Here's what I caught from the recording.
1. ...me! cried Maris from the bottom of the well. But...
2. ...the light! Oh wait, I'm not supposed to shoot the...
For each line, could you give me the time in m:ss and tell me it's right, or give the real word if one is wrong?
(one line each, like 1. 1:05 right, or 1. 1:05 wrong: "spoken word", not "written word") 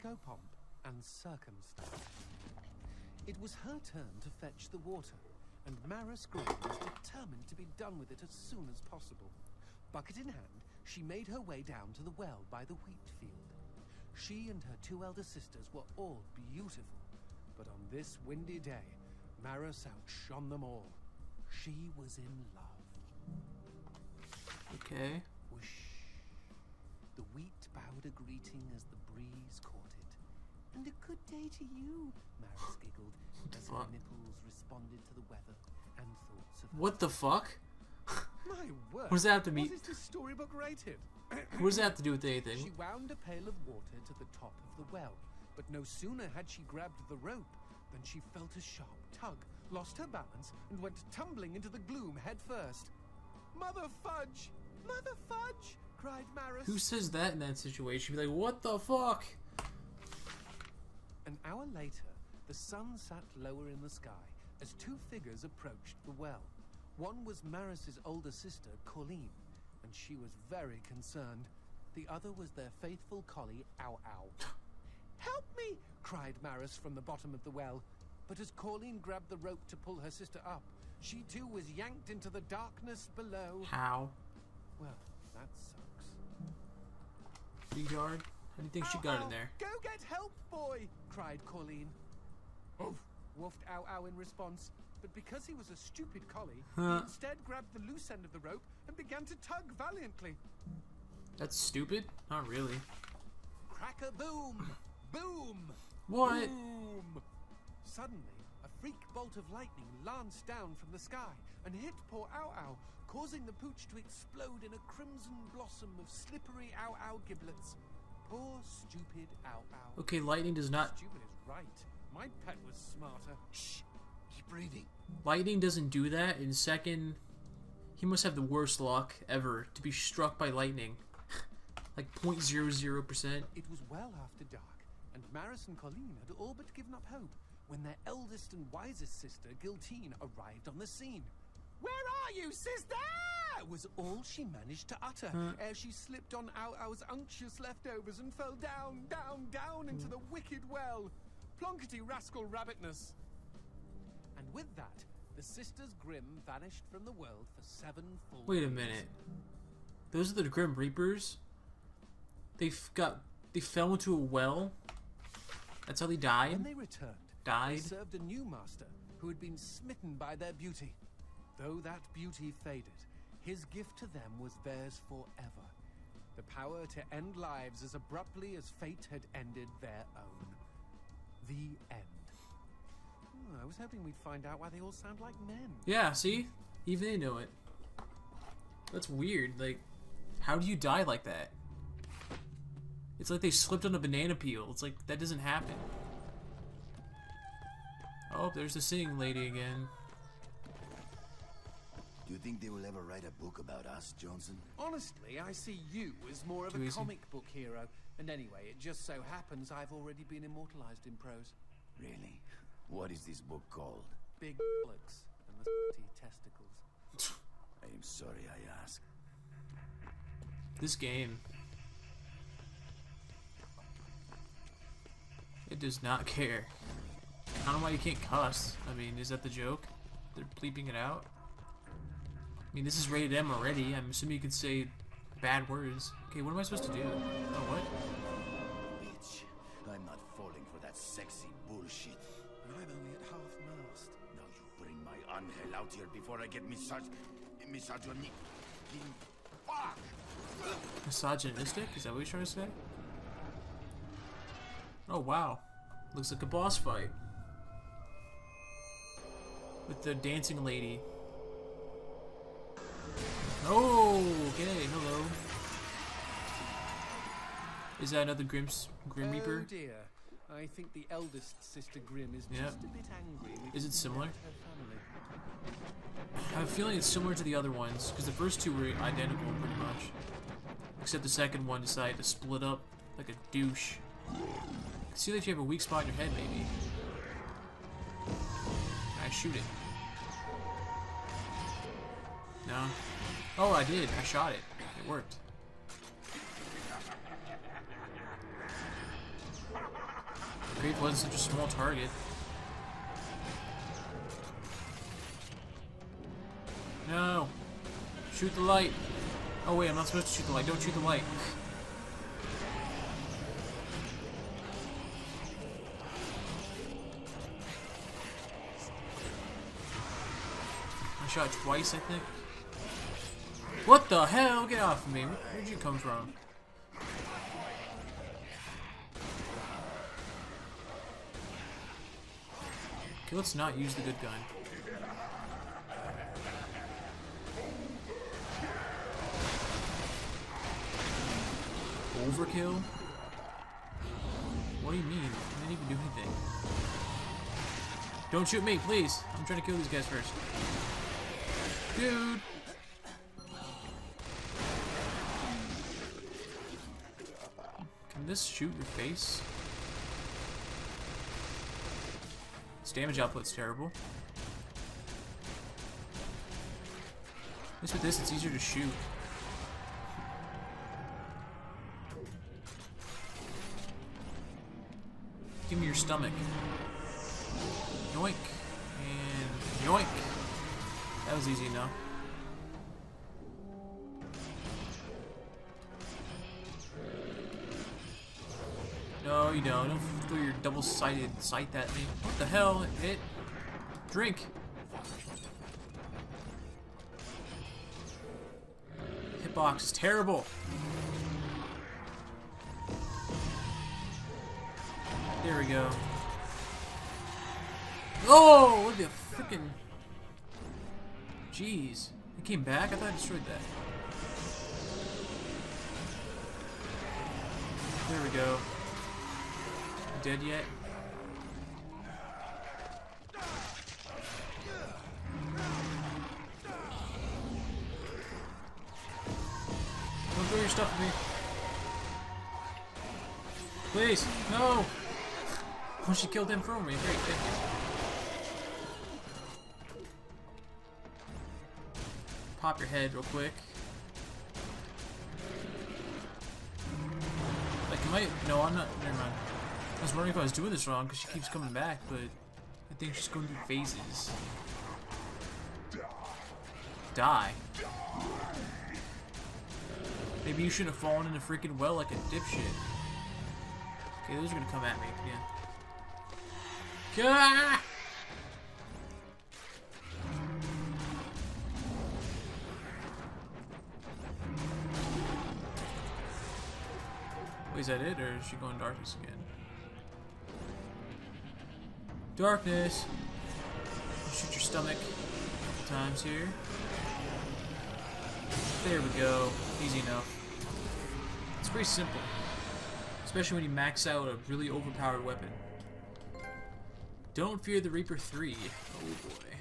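1. 1:15 right
2. 5:08 right.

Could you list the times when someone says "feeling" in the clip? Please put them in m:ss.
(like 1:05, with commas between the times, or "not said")
4:36.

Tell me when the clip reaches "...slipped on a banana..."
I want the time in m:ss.
3:13.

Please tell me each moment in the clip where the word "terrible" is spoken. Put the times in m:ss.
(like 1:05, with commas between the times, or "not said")
6:03, 6:39.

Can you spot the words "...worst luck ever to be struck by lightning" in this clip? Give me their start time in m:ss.
2:08.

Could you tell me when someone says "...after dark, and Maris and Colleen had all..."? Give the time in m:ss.
2:14.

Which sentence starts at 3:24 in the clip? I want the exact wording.
Honestly, I see you as more of Too a easy.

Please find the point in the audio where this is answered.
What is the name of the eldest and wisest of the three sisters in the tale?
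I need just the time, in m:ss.
2:19.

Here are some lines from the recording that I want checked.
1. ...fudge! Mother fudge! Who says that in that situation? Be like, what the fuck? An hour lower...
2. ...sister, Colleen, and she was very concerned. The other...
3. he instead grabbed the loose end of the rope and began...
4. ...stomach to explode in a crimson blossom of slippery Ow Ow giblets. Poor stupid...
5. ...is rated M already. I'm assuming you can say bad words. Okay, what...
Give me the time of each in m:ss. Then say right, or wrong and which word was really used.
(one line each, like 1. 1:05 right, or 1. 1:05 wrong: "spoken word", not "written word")
1. 0:54 wrong: "later", not "lower"
2. 1:08 right
3. 1:36 right
4. 1:53 wrong: "pooch", not "stomach"
5. 3:52 right.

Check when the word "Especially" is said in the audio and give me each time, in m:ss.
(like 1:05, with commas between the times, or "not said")
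8:13.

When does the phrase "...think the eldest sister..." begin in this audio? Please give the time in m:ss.
4:30.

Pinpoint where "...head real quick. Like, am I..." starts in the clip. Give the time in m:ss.
7:22.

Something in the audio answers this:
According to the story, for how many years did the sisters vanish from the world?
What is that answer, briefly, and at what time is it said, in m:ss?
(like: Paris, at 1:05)
7, at 2:37.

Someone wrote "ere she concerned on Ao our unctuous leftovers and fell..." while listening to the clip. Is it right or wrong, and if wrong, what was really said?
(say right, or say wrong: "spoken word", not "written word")
wrong: "slipped", not "concerned".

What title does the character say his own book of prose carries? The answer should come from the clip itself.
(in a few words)
Big Bullocks and the Testicles.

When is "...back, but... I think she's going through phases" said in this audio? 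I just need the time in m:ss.
7:31.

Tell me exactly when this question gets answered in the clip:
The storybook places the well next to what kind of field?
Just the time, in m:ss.
0:12.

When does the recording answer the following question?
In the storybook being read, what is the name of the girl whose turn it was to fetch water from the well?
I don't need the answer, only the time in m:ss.
0:05.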